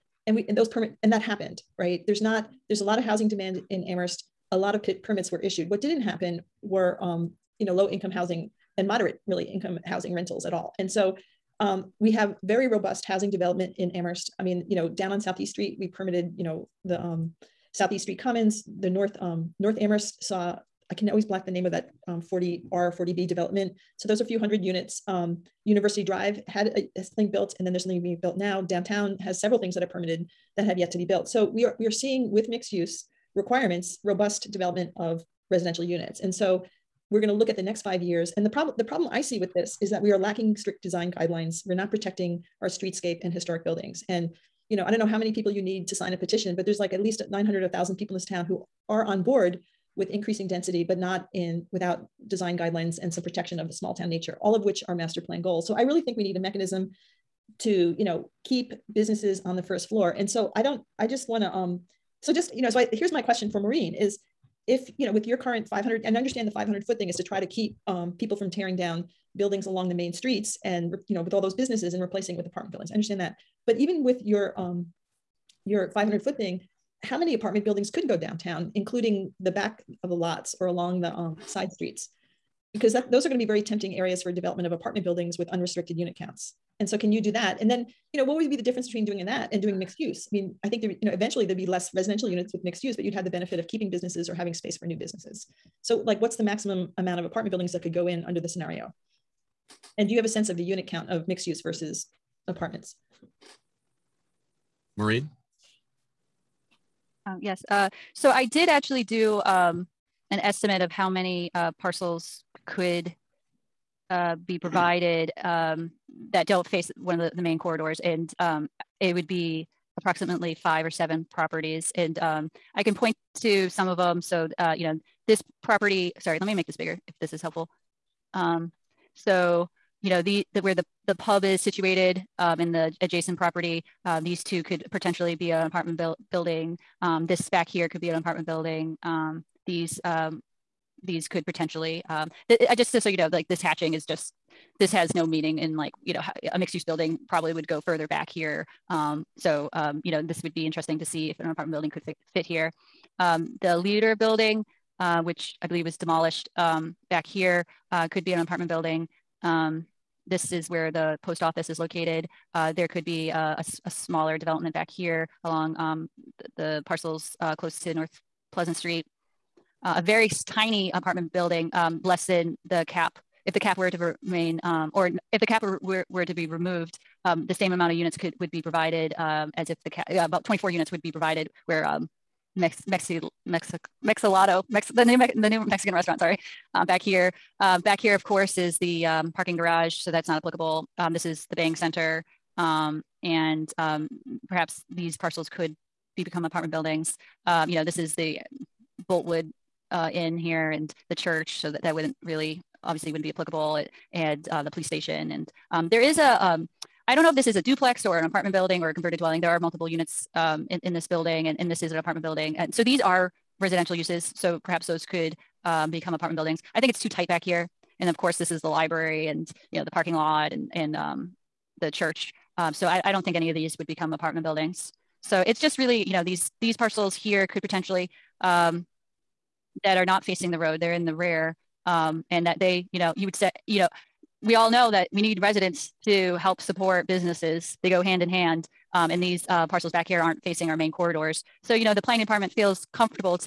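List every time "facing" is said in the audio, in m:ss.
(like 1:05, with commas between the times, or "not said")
3:50, 4:00.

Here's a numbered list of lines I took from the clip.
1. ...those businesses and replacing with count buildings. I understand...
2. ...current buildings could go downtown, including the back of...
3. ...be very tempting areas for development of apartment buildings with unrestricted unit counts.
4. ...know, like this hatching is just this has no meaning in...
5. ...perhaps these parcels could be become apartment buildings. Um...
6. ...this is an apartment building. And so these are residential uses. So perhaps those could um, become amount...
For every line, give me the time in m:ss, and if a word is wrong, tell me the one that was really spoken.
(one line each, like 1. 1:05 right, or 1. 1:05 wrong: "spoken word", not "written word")
1. 1:11 wrong: "apartment", not "count"
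2. 1:17 wrong: "apartment", not "current"
3. 1:23 right
4. 2:23 right
5. 3:14 right
6. 3:31 wrong: "apartment", not "amount".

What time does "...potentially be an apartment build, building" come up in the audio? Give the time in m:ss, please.
2:14.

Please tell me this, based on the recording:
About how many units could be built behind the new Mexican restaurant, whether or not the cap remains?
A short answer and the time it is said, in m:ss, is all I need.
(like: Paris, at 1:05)
24, at 3:00.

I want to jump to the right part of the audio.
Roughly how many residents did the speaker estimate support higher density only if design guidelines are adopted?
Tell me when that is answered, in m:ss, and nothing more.
0:47.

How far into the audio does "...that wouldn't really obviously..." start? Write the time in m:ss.
3:21.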